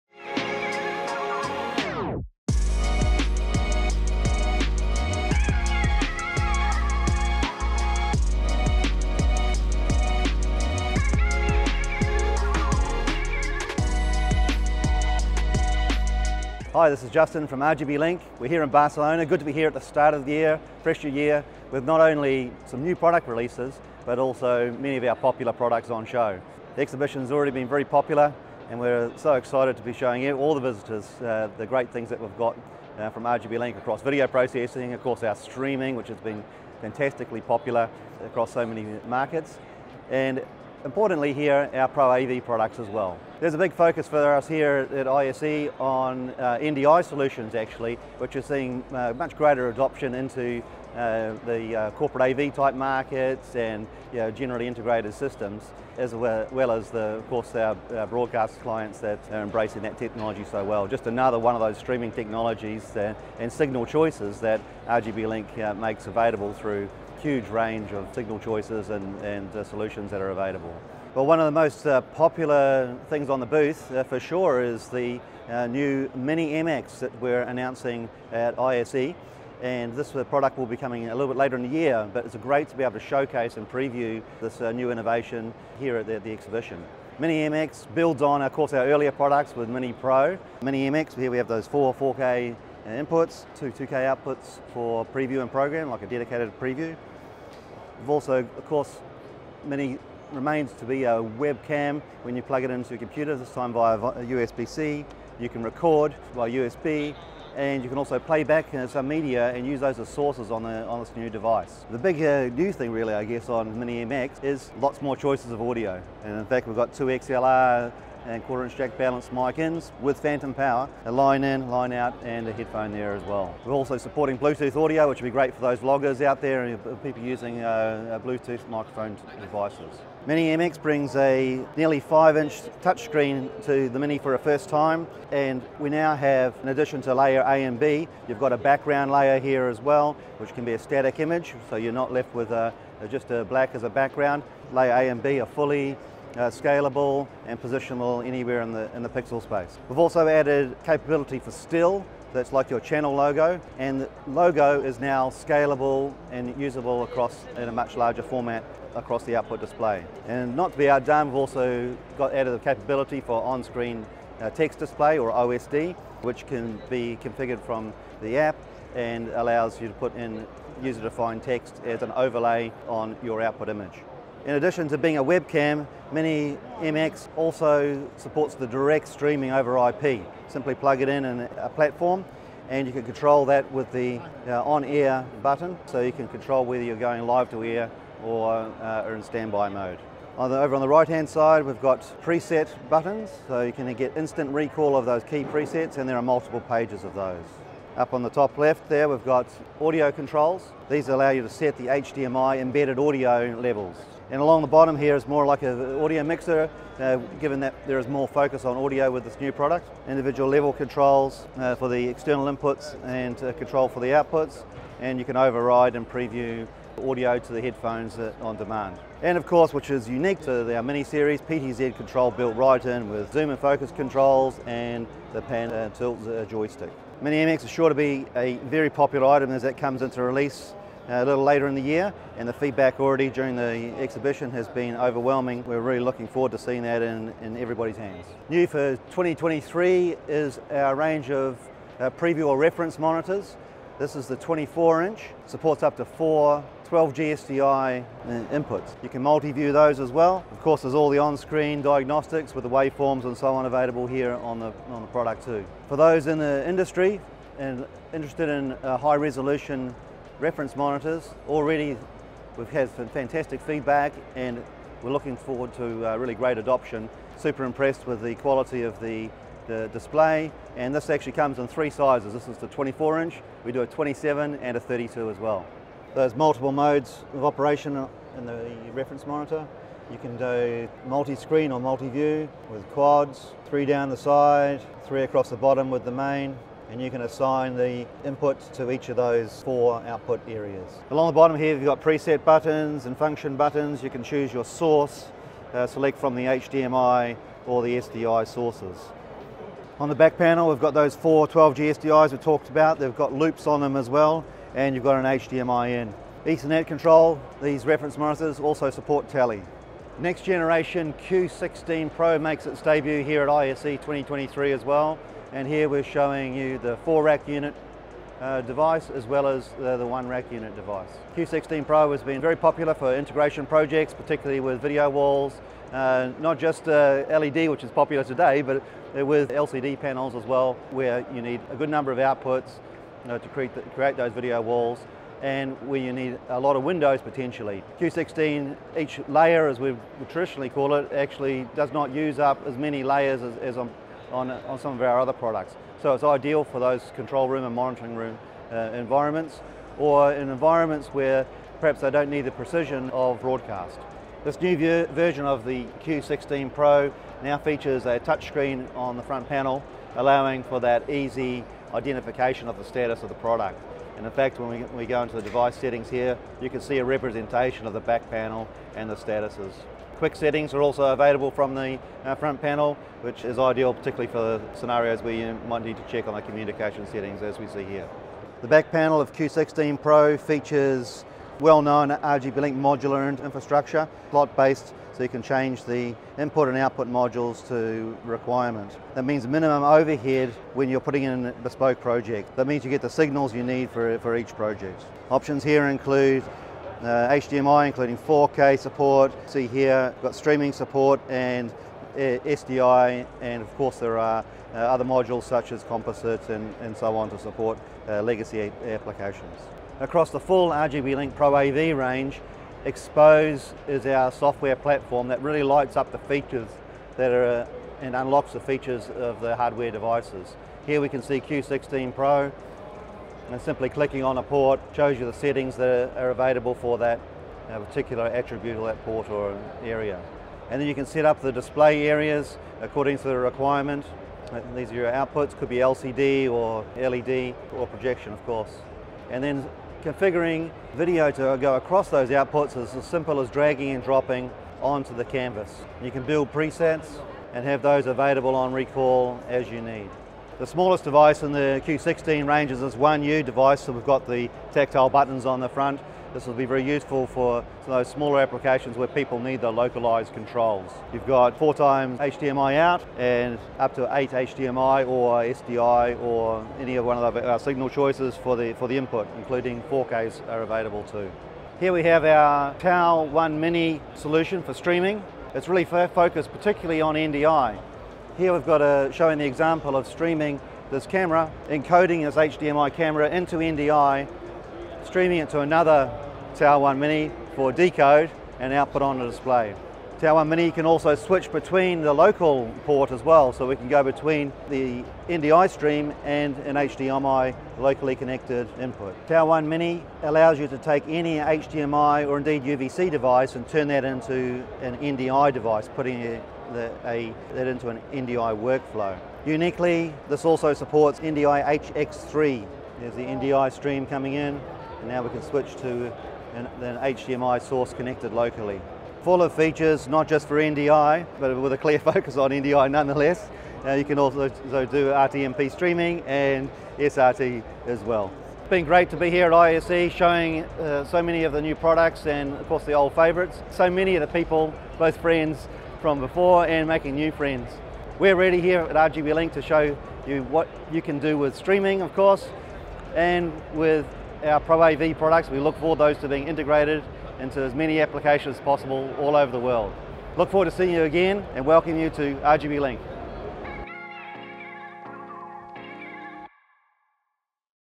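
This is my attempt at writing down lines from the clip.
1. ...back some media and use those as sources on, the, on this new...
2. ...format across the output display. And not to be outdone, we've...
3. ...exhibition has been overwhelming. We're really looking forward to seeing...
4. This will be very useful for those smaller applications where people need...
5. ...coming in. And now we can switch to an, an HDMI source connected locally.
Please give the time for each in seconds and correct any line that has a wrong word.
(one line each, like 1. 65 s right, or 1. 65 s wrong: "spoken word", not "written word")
1. 108 s right
2. 158 s right
3. 233 s right
4. 456 s right
5. 514 s right.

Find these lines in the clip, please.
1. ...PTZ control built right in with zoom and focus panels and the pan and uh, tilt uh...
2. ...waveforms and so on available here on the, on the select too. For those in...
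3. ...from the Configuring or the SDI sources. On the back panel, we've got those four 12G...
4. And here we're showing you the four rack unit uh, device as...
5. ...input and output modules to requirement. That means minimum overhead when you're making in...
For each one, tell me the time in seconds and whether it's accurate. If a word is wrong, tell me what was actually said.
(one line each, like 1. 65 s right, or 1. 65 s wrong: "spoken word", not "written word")
1. 221 s wrong: "controls", not "panels"
2. 252 s wrong: "product", not "select"
3. 296 s wrong: "HDMI", not "Configuring"
4. 315 s right
5. 386 s wrong: "putting", not "making".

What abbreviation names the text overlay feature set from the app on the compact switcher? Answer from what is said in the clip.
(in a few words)
OSD.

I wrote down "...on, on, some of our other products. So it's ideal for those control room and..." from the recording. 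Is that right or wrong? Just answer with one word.
right.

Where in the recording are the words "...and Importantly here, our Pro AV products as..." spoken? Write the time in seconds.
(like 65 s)
40 s.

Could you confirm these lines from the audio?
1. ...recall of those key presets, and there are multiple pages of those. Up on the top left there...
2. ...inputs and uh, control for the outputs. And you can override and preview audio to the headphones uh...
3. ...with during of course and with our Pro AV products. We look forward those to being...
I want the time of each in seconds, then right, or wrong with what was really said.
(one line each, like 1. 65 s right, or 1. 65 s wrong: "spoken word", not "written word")
1. 194 s right
2. 212 s right
3. 541 s wrong: "streaming", not "during".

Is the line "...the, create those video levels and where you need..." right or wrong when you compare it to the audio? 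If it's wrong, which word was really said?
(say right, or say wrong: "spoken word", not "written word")
wrong: "walls", not "levels".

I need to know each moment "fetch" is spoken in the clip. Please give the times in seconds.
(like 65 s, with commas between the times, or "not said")
not said.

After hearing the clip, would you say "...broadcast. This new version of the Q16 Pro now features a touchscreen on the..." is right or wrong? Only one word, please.
right.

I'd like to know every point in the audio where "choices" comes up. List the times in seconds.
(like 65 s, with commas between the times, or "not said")
63 s, 68 s, 115 s, 467 s.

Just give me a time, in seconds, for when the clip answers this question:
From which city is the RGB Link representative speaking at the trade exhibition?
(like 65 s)
18 s.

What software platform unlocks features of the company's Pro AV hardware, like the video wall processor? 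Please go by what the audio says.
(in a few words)
XPOSE.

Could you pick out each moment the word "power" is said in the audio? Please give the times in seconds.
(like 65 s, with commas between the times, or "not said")
120 s.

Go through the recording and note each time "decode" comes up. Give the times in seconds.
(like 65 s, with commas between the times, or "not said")
487 s.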